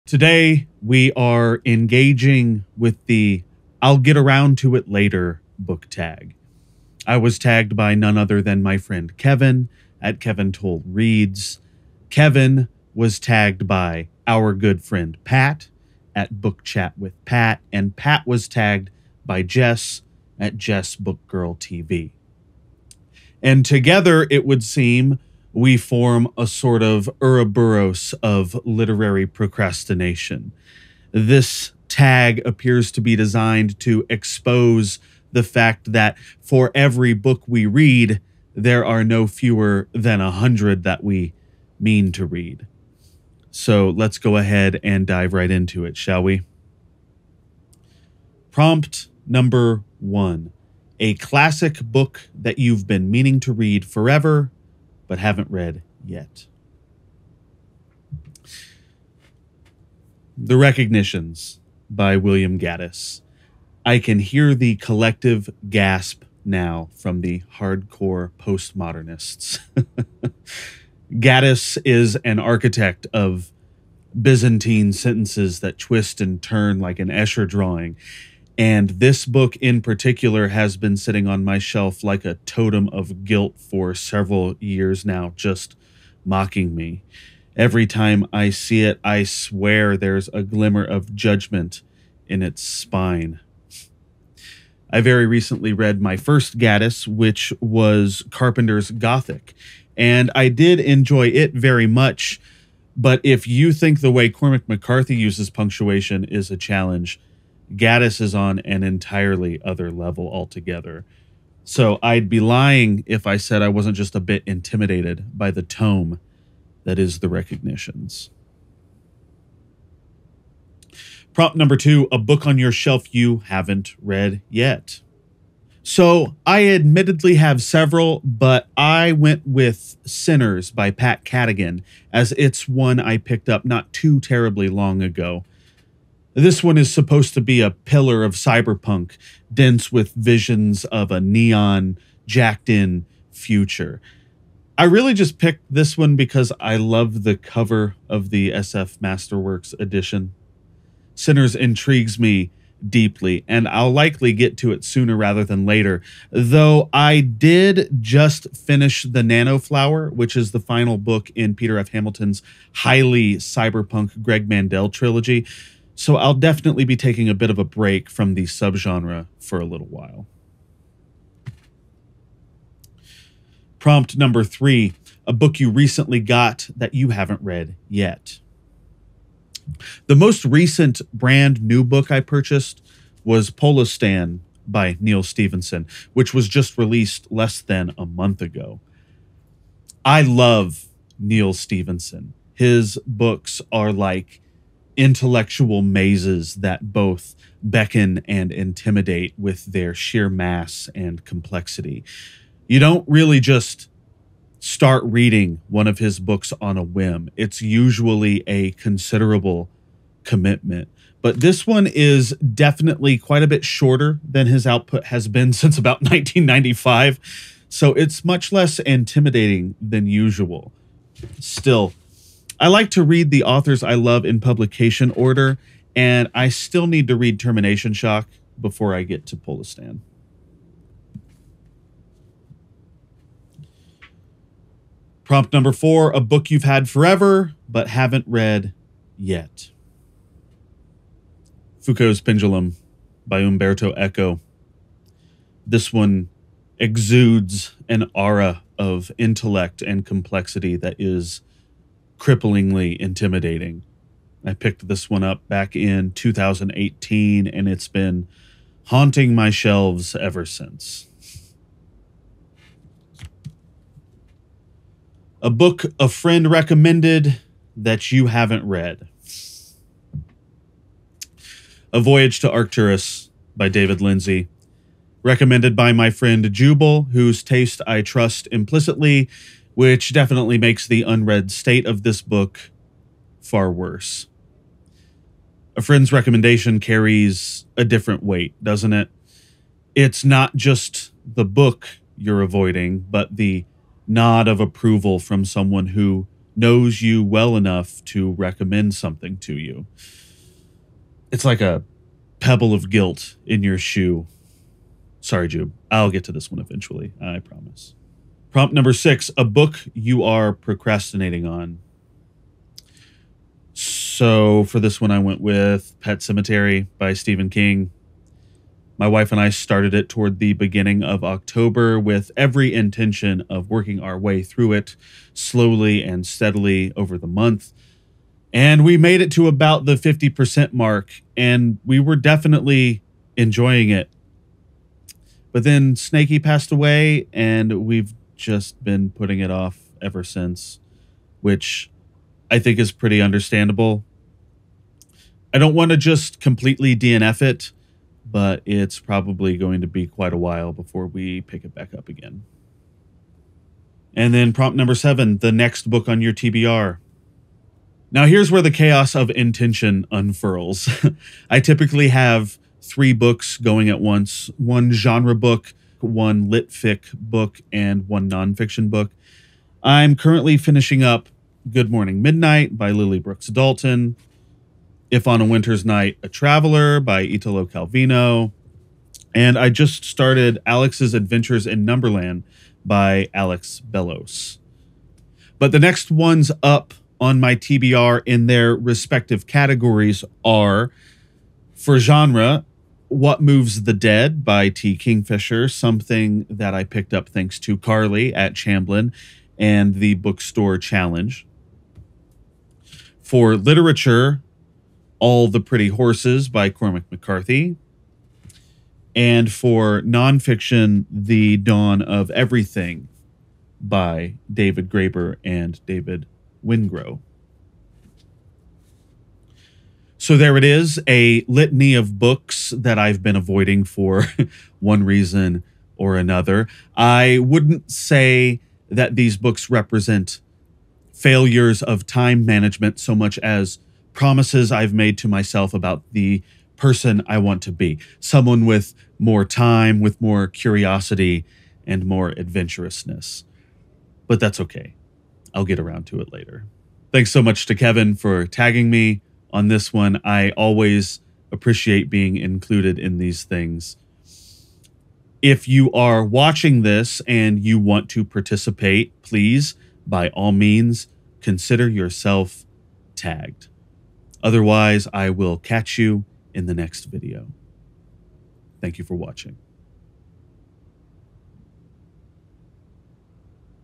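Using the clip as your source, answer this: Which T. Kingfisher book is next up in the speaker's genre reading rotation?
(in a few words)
What Moves the Dead.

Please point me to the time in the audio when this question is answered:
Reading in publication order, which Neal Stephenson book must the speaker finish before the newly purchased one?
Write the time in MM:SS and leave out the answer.
03:47.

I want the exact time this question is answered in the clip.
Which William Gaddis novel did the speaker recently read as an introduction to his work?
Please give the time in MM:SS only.
01:38.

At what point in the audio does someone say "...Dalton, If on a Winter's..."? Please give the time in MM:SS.
06:13.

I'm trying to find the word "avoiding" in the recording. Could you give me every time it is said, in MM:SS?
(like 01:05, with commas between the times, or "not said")
04:52, 07:03.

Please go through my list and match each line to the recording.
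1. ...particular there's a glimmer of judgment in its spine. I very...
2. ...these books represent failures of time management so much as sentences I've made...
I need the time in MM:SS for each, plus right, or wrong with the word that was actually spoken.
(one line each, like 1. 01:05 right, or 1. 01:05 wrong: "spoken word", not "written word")
1. 01:29 wrong: "swear", not "particular"
2. 07:09 wrong: "promises", not "sentences".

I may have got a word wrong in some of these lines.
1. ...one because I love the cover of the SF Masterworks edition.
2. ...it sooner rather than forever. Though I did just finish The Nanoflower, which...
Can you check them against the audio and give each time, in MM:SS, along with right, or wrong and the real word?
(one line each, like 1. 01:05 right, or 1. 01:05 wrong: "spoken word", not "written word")
1. 02:25 right
2. 02:34 wrong: "later", not "forever".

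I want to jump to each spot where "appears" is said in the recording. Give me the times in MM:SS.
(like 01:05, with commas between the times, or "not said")
00:32.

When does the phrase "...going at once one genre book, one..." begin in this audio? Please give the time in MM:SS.
06:03.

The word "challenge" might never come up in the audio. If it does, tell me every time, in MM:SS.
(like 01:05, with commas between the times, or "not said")
01:46, 06:40.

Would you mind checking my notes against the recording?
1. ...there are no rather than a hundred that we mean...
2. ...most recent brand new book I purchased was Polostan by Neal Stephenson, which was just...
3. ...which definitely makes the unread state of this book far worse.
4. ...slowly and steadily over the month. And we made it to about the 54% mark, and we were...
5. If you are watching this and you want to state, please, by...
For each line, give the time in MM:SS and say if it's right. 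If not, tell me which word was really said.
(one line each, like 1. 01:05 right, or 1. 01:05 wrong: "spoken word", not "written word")
1. 00:38 wrong: "fewer", not "rather"
2. 03:00 right
3. 04:39 right
4. 05:25 wrong: "50", not "54"
5. 07:35 wrong: "participate", not "state".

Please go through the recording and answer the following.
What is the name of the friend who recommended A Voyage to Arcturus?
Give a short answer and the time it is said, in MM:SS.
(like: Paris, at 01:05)
Jubal, at 04:36.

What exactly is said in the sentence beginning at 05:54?
And then prompt number seven, the next book on your TBR.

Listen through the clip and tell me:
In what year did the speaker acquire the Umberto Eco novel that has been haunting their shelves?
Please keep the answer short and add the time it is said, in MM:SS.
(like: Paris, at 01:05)
2018, at 04:16.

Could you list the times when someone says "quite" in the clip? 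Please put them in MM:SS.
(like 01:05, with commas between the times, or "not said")
03:33, 05:50.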